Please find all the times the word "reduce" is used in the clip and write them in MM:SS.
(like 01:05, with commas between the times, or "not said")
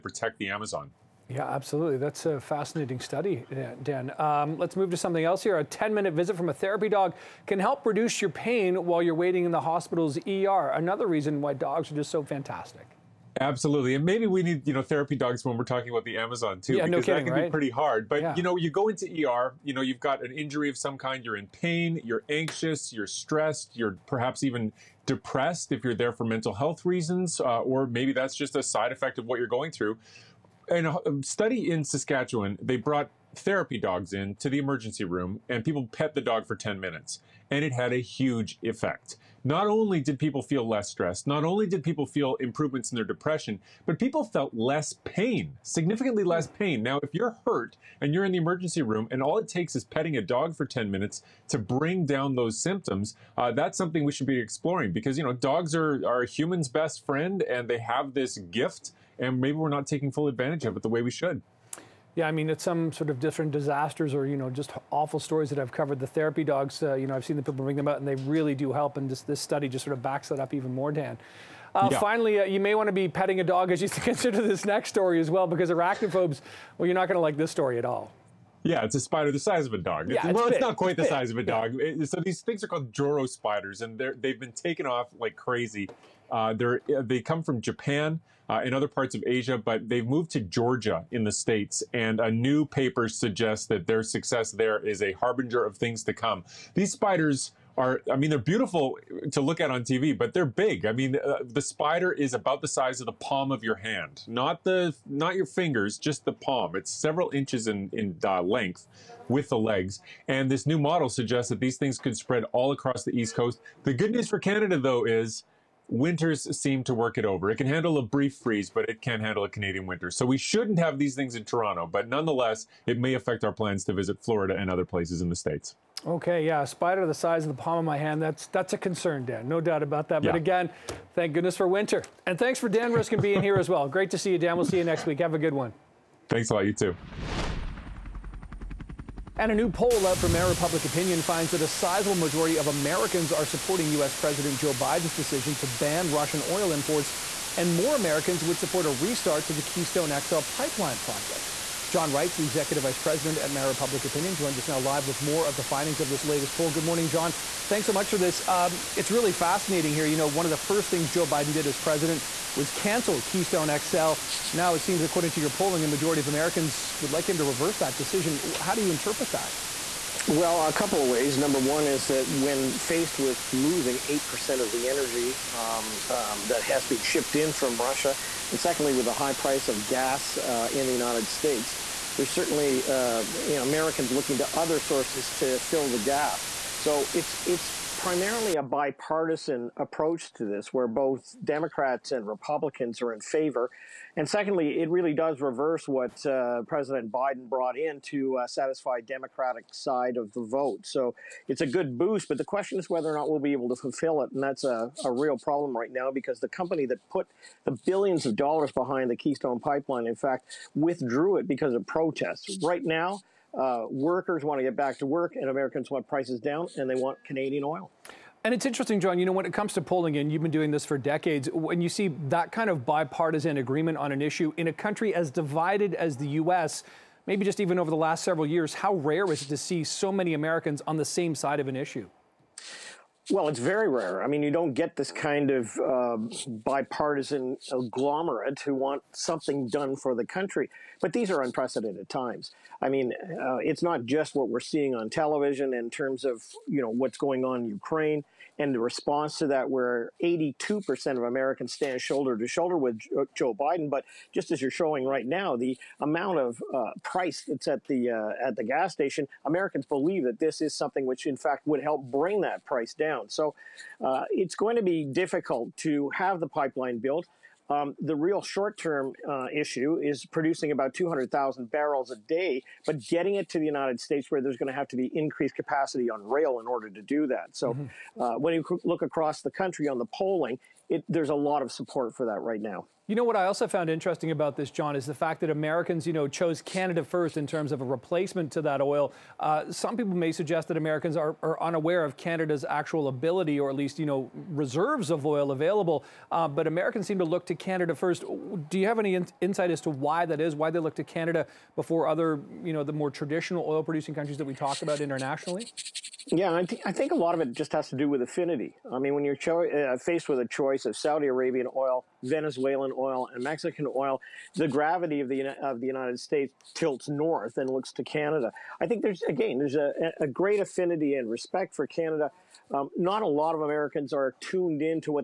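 00:07.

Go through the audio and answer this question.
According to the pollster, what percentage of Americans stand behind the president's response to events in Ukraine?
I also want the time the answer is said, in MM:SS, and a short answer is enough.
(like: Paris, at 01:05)
82%, at 04:10.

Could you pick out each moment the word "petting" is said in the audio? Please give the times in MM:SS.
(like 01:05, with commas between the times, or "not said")
00:49, 01:13.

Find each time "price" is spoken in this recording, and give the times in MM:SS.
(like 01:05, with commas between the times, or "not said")
02:59, 03:36, 04:17, 04:22.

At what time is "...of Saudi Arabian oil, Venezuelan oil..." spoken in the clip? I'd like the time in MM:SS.
05:10.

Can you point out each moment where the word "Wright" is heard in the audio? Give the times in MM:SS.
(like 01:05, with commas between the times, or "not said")
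02:32.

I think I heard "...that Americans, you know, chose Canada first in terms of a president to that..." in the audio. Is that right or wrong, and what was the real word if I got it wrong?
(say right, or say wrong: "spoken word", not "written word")
wrong: "replacement", not "president".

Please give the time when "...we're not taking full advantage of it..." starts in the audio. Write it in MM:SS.
00:59.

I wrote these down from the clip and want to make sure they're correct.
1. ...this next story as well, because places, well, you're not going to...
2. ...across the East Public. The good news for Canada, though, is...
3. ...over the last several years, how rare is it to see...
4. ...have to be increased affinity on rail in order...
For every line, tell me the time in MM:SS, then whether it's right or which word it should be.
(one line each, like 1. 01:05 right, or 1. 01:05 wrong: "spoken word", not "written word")
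1. 01:14 wrong: "arachnophobes", not "places"
2. 01:52 wrong: "Coast", not "Public"
3. 03:47 right
4. 04:34 wrong: "capacity", not "affinity".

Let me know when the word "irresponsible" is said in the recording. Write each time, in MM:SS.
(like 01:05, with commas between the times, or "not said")
not said.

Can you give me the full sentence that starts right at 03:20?
So it's a good boost, but the question is whether or not we'll be able to fulfill it.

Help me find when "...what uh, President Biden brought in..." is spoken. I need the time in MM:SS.
03:15.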